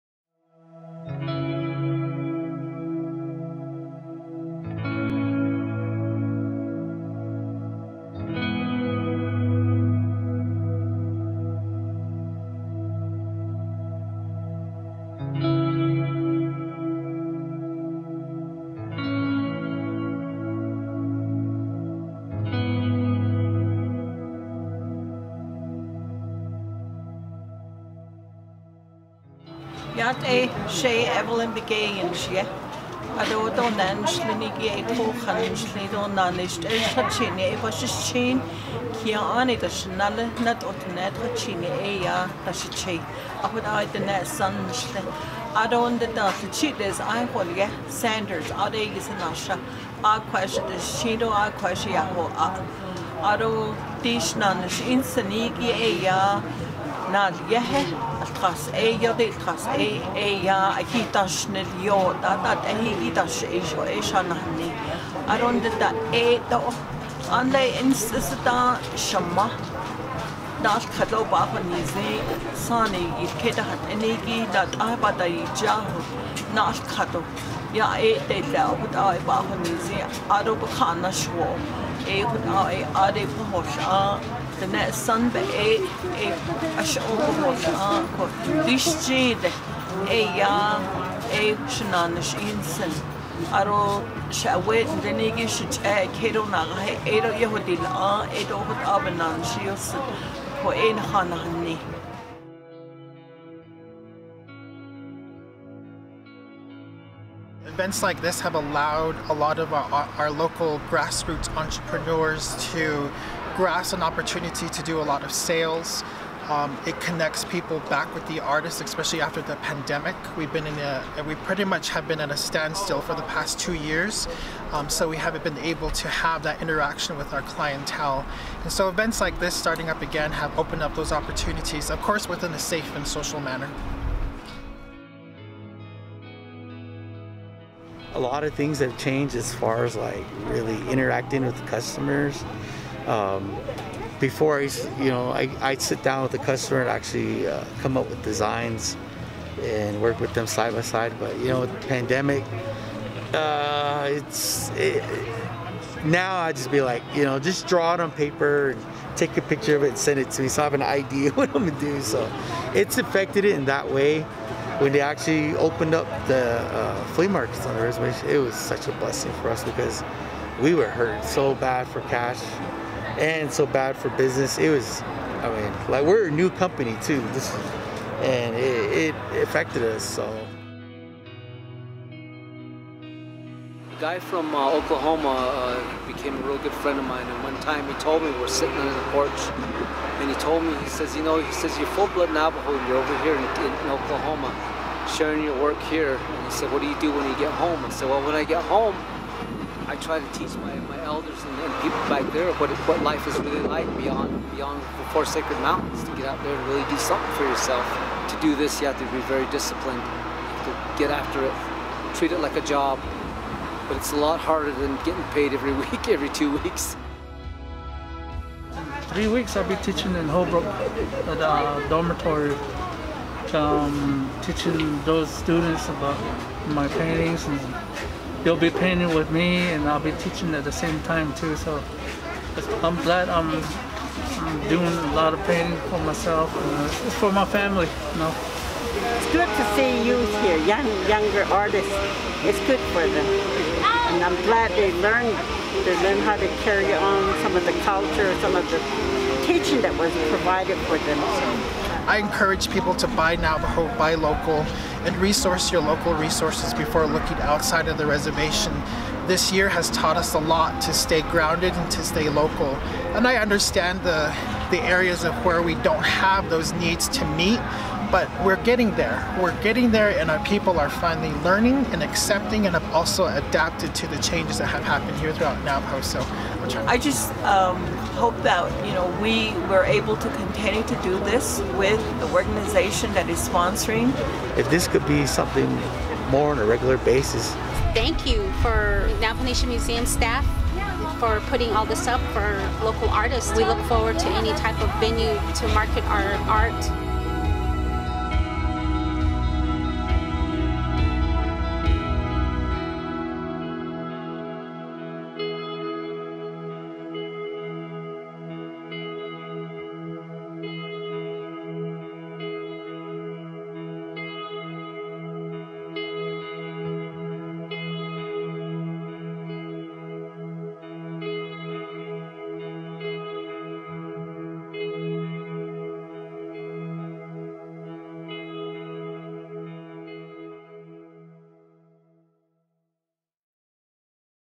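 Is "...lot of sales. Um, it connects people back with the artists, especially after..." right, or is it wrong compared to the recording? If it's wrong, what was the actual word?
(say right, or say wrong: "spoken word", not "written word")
right.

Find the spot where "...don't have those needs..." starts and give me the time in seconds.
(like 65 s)
265 s.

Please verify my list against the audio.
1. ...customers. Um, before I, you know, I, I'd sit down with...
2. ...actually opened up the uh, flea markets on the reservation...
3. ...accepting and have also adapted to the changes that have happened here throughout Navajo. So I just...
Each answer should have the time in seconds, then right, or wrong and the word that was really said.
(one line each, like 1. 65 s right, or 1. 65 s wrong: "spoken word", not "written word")
1. 141 s right
2. 164 s right
3. 272 s right.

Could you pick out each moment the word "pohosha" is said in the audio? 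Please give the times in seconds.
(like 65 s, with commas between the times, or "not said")
83 s, 87 s.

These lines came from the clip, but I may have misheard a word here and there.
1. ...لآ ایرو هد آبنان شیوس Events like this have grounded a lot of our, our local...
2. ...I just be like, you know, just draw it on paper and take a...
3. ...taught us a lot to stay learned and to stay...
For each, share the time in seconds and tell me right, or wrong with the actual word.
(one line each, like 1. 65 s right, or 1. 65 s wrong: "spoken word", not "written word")
1. 97 s wrong: "allowed", not "grounded"
2. 156 s right
3. 259 s wrong: "grounded", not "learned".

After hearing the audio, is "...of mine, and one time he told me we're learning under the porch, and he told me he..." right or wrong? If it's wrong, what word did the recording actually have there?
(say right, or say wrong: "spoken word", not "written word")
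wrong: "sitting", not "learning".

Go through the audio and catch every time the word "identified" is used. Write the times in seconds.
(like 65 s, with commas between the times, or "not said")
not said.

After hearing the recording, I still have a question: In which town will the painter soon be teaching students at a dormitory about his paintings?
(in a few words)
Holbrook.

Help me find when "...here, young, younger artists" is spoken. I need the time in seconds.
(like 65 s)
240 s.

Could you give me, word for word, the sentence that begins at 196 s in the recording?
And he said, what do you do when you get home?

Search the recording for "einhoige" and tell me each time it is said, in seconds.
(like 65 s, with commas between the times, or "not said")
47 s.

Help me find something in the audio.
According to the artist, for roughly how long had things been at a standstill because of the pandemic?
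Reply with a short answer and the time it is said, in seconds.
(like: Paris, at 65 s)
2 years, at 123 s.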